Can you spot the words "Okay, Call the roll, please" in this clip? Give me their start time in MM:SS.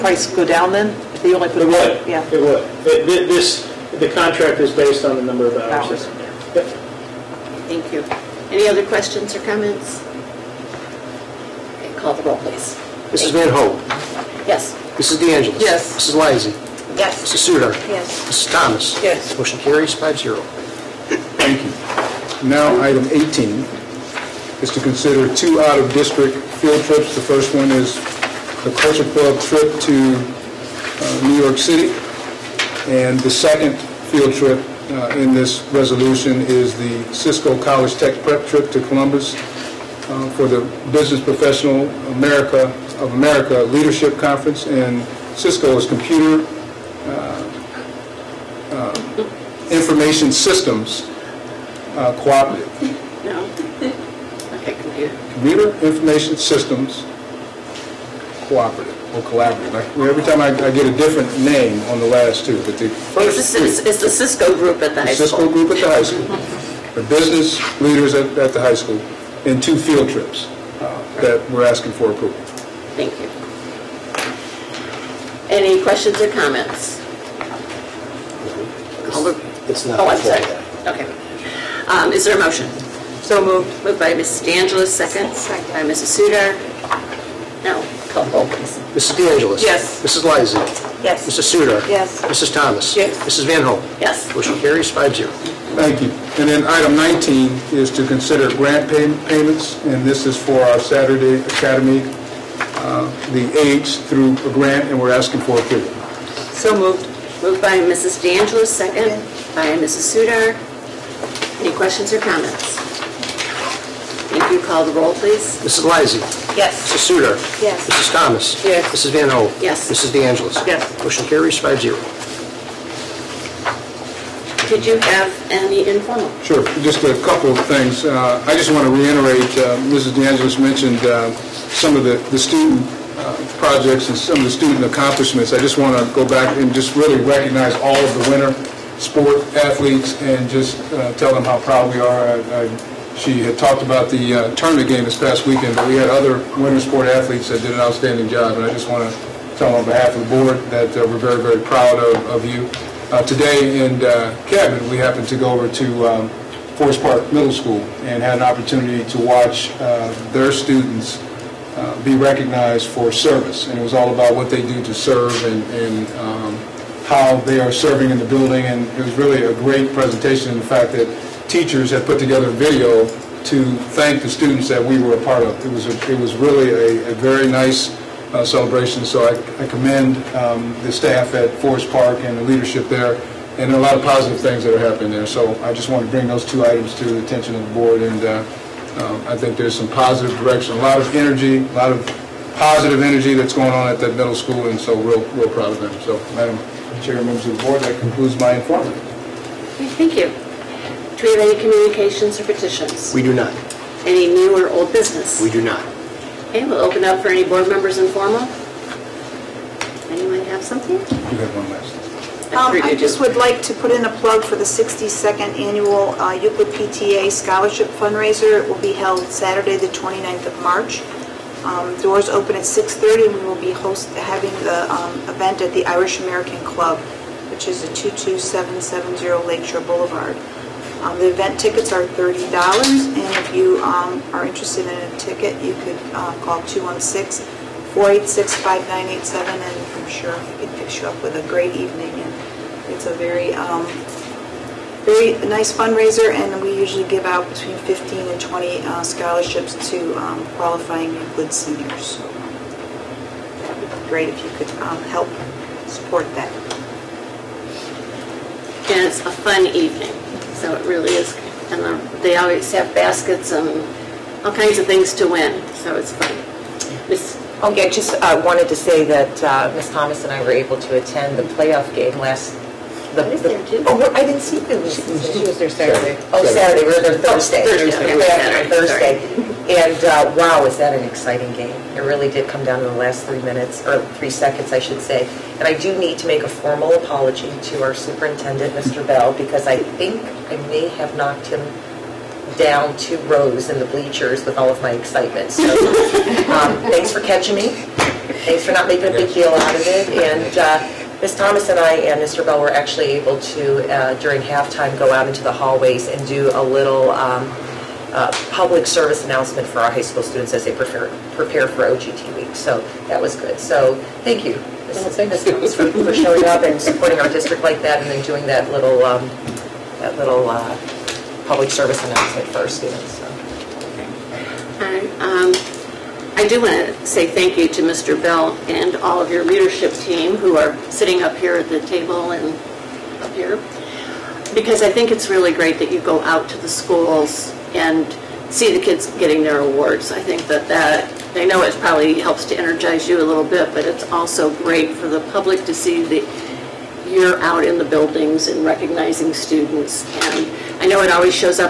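00:11.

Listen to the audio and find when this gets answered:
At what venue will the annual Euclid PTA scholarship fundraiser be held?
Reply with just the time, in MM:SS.
03:45.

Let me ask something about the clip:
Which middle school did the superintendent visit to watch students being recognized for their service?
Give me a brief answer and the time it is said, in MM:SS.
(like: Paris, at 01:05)
Forest Park Middle School, at 02:36.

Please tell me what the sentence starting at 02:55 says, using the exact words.
It was, a, it was really a, a very nice uh, celebration.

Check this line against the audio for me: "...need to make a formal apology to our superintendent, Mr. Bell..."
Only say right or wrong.
right.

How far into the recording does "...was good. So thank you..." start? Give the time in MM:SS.
05:13.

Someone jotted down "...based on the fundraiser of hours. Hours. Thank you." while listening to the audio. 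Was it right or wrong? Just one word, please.
wrong.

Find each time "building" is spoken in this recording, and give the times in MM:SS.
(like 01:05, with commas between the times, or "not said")
02:48, 05:47.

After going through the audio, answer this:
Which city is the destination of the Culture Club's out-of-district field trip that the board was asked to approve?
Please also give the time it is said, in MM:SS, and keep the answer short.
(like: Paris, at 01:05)
New York City, at 00:31.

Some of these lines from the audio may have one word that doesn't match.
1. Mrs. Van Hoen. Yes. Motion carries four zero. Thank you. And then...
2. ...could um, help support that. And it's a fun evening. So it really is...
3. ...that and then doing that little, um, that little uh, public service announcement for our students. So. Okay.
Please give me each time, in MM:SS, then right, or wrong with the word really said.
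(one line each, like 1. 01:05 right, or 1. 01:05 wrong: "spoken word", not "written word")
1. 01:33 wrong: "five", not "four"
2. 04:14 right
3. 05:17 right.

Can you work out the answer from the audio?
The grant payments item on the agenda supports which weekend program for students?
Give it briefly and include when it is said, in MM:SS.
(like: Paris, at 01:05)
Saturday Academy, at 01:40.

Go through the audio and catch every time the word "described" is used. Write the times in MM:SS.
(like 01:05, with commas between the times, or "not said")
not said.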